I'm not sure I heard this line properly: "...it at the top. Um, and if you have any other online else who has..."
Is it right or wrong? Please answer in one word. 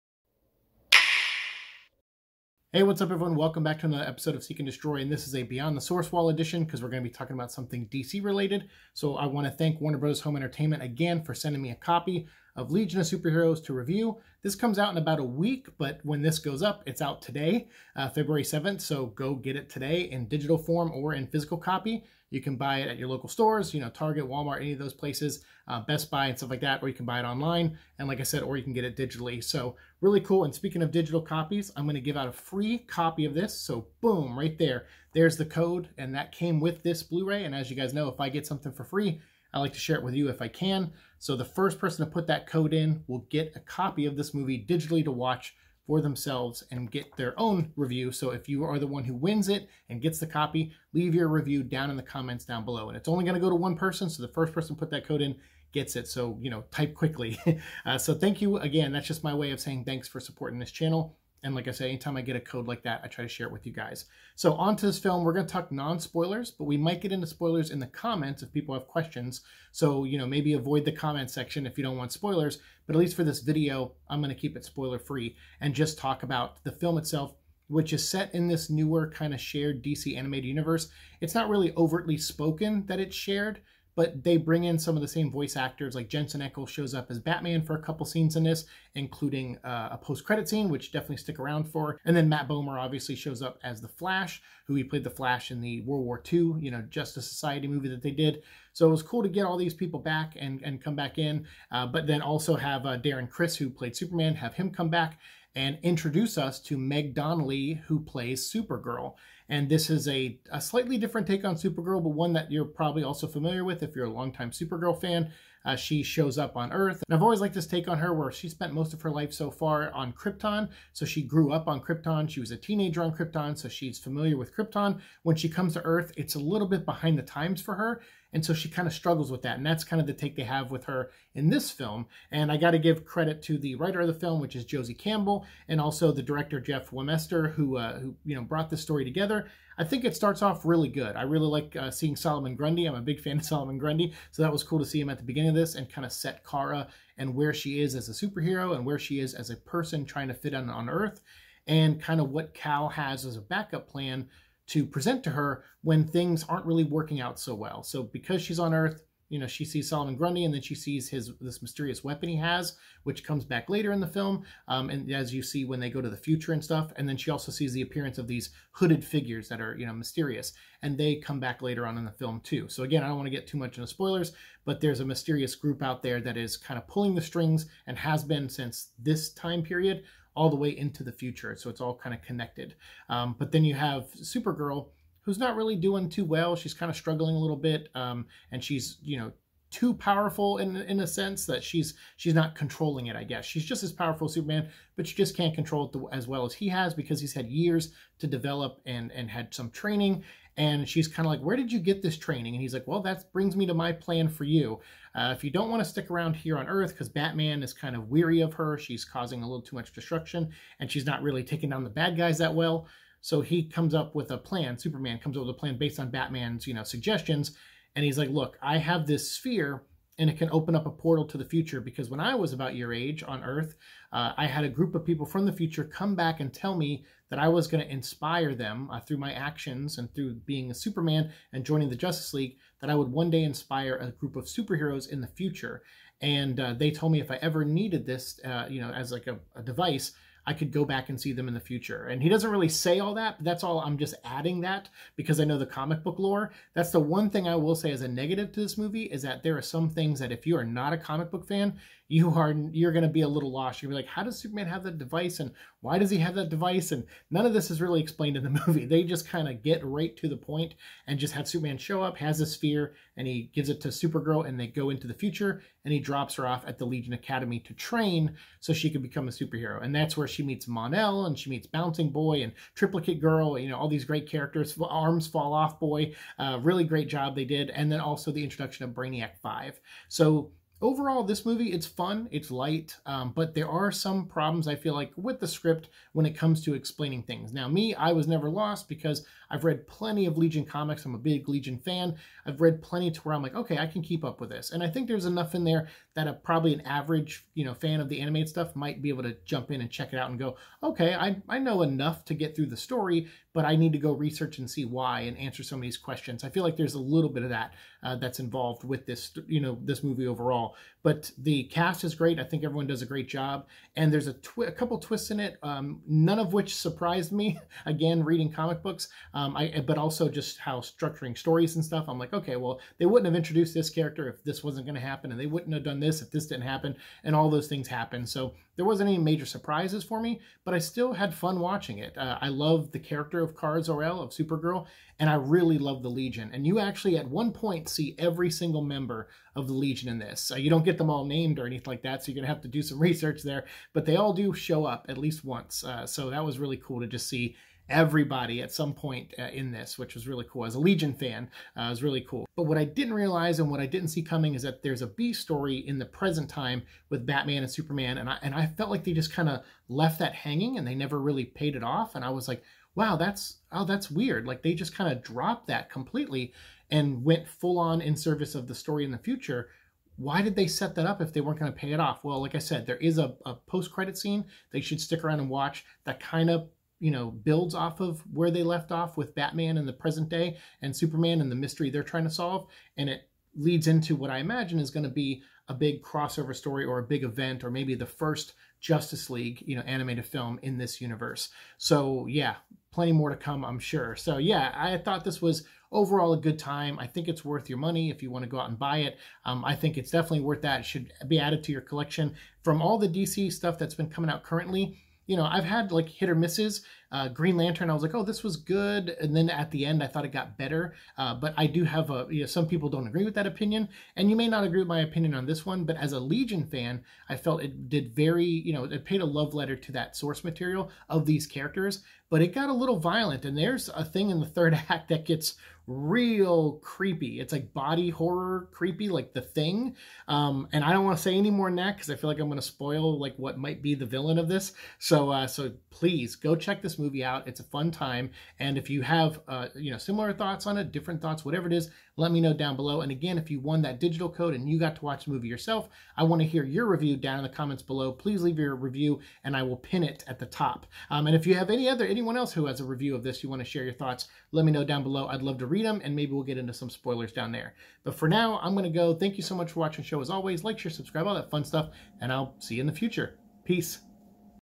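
wrong.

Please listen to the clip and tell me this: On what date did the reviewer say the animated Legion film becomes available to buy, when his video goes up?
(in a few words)
February 7th.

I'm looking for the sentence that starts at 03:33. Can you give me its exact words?
So he comes up with a plan.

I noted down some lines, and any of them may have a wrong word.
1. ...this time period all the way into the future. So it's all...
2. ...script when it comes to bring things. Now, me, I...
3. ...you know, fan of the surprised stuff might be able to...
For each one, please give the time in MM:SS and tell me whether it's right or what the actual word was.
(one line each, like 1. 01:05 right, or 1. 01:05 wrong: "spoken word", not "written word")
1. 02:59 right
2. 04:45 wrong: "explaining", not "bring"
3. 04:57 wrong: "animated", not "surprised".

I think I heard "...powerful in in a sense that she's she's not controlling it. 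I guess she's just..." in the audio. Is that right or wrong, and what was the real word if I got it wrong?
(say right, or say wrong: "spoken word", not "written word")
right.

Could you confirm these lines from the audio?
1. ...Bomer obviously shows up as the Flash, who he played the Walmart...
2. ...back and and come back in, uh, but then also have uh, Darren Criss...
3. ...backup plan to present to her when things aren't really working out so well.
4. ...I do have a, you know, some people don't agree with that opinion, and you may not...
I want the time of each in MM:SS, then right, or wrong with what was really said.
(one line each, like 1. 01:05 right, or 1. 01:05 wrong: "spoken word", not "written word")
1. 01:32 wrong: "Flash", not "Walmart"
2. 01:39 right
3. 02:33 right
4. 06:51 right.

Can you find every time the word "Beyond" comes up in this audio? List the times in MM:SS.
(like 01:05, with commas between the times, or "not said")
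00:05.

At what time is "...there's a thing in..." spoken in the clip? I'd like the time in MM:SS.
07:03.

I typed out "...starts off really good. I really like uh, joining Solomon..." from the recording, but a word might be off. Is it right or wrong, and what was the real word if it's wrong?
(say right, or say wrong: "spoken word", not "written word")
wrong: "seeing", not "joining".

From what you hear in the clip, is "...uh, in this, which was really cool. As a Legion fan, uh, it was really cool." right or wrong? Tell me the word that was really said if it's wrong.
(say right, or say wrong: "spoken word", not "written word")
right.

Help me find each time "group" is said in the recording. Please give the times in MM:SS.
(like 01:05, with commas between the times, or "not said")
02:55, 03:44, 03:54.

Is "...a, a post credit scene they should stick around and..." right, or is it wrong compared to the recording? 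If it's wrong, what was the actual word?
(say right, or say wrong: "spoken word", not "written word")
right.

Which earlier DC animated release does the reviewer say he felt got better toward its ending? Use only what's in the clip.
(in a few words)
Green Lantern.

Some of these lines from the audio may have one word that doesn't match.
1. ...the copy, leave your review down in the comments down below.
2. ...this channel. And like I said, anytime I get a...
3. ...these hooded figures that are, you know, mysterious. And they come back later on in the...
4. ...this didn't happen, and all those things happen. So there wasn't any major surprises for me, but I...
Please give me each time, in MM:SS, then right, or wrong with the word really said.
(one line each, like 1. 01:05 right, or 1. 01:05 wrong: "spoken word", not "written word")
1. 00:50 right
2. 01:00 right
3. 02:48 right
4. 05:26 right.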